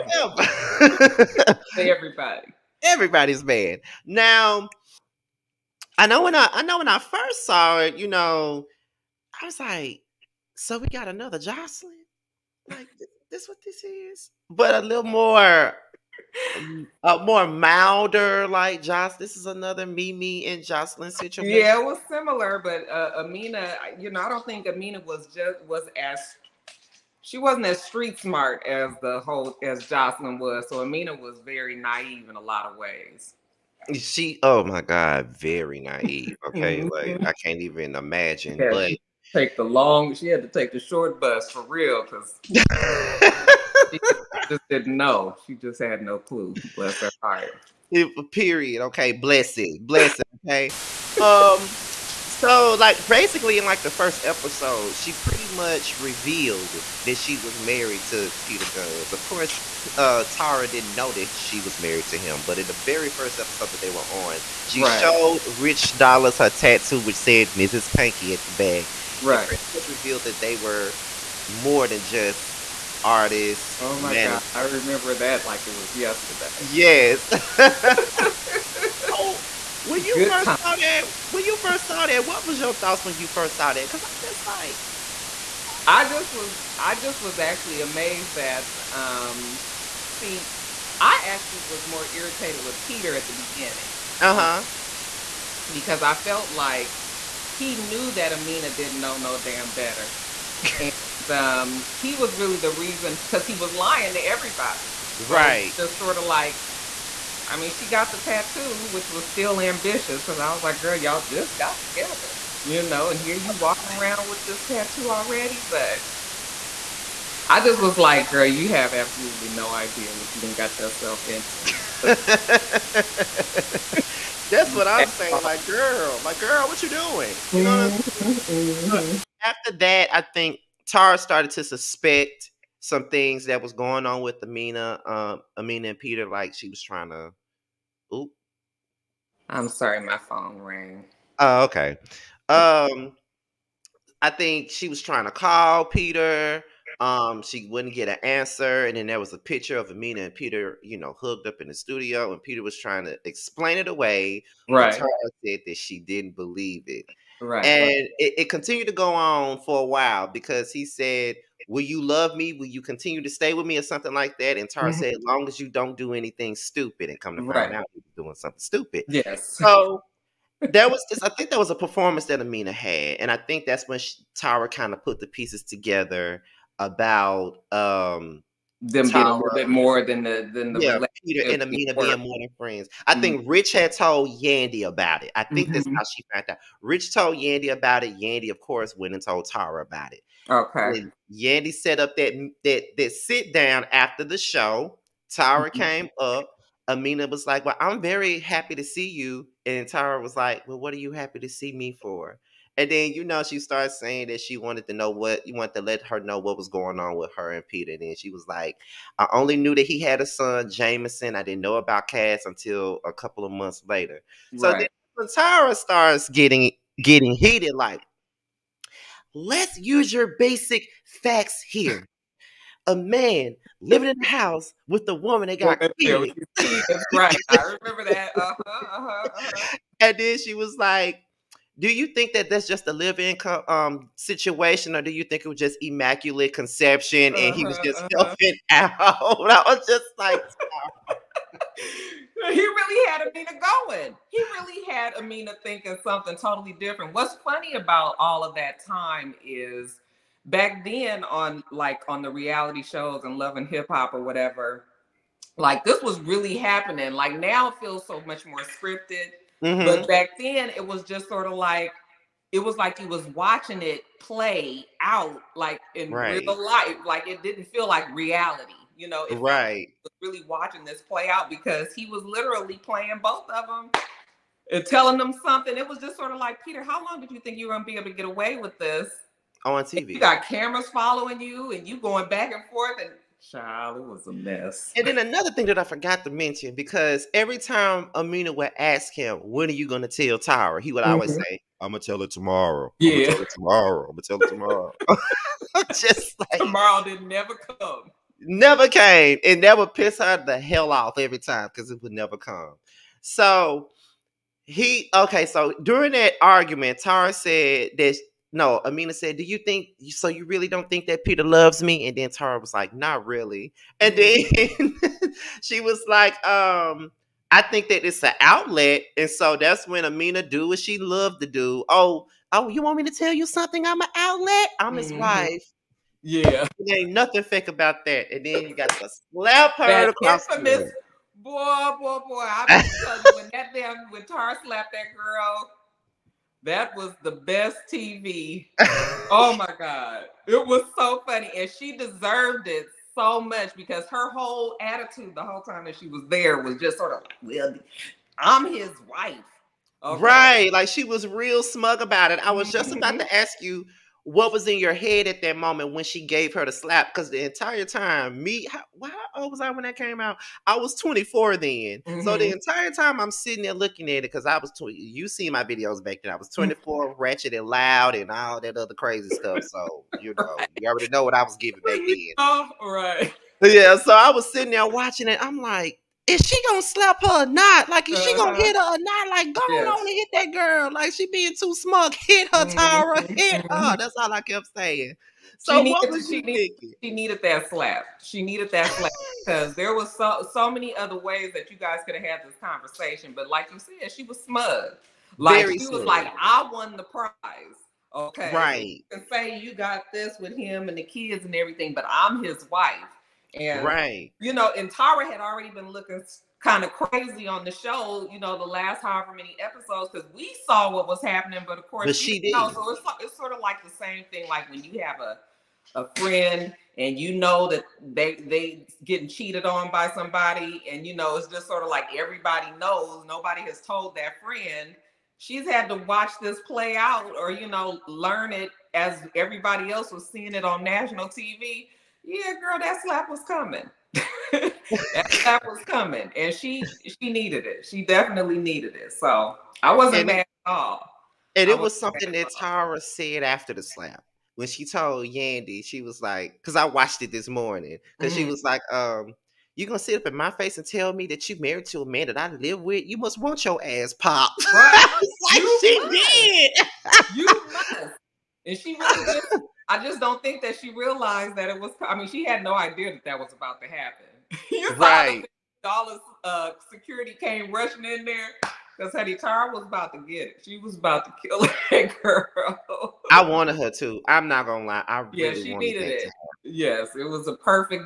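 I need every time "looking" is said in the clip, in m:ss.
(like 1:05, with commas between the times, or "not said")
6:03, 6:45.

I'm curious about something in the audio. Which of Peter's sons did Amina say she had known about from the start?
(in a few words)
Jamison.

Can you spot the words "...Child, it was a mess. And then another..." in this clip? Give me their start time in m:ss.
4:43.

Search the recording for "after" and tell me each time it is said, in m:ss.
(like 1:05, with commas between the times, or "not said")
2:09, 3:13, 7:23.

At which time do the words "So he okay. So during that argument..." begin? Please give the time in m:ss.
5:03.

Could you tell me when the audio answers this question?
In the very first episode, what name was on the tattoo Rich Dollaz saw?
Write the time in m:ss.
1:07.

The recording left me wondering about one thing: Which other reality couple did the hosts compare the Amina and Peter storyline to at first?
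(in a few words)
Mimi and Joseline.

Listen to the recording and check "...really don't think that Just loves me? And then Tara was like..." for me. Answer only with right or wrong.
wrong.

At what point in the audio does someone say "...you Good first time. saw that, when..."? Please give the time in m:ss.
1:20.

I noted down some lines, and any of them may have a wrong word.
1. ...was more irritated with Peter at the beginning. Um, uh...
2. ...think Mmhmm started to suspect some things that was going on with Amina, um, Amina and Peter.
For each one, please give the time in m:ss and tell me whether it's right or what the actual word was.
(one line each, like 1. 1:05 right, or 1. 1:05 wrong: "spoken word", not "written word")
1. 1:31 right
2. 2:10 wrong: "Tara", not "Mmhmm".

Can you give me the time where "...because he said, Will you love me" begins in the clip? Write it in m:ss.
2:40.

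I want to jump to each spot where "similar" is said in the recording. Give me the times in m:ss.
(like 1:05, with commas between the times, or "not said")
0:22.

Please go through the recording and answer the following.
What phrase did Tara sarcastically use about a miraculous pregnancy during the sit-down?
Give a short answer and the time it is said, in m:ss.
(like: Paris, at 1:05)
immaculate conception, at 3:55.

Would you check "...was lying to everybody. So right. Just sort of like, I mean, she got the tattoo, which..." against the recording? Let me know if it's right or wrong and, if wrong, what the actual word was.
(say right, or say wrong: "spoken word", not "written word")
right.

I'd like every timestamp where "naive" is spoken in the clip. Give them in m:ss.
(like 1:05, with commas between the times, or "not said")
0:31, 0:35.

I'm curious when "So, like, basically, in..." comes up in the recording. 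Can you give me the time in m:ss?
0:52.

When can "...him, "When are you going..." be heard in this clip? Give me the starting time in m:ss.
4:49.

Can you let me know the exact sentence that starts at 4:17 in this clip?
Like now it feels so much more scripted Mm-hmm.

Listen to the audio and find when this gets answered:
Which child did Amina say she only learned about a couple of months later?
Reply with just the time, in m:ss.
3:32.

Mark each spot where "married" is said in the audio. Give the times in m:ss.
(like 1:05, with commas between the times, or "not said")
0:57, 1:01, 7:31.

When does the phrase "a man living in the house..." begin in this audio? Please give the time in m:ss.
3:42.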